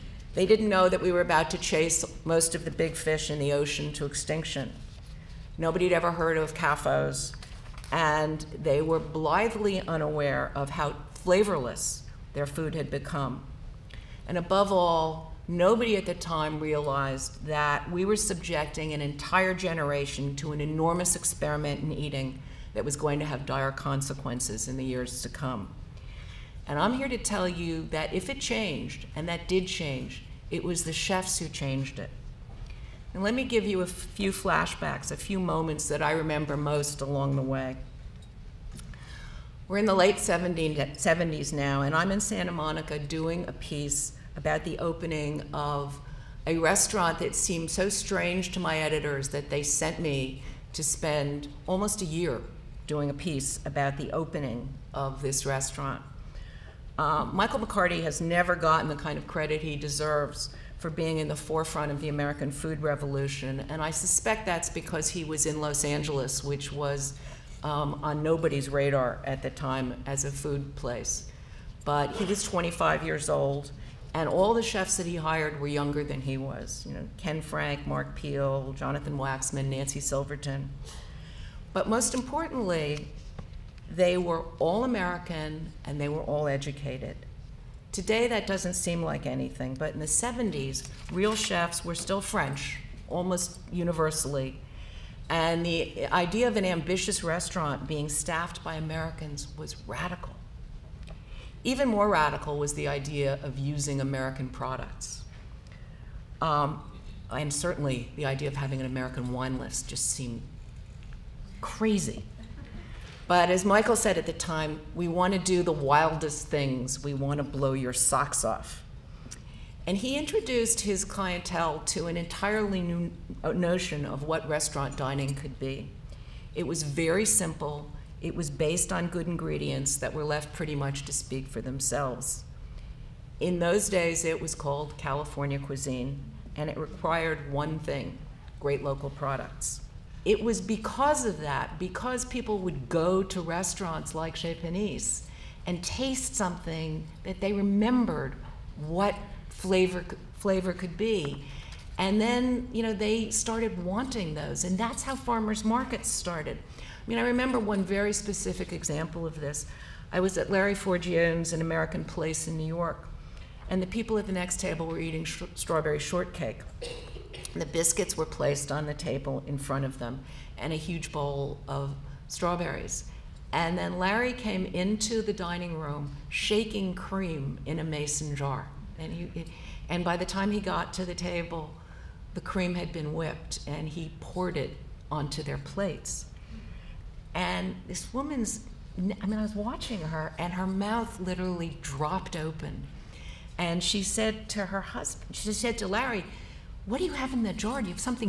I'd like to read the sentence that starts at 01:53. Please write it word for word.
But as Michael said at the time, we want to do the wildest things.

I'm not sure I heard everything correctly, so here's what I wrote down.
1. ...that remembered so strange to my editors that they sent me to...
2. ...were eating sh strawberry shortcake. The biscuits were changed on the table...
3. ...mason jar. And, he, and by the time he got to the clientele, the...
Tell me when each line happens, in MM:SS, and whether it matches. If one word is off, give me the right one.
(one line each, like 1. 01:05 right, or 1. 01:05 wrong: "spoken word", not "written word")
1. 00:47 wrong: "seemed", not "remembered"
2. 02:44 wrong: "placed", not "changed"
3. 02:57 wrong: "table", not "clientele".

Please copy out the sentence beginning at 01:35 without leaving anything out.
And the idea of an ambitious restaurant being staffed by Americans was radical.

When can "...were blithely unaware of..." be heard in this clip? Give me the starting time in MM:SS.
00:08.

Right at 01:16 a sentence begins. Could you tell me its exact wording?
You know, Ken Frank, Mark Peel, Jonathan Waxman, Nancy Silverton.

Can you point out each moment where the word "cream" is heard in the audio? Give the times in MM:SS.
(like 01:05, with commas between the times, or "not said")
02:56, 03:02.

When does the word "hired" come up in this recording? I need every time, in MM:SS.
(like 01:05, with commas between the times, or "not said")
01:15.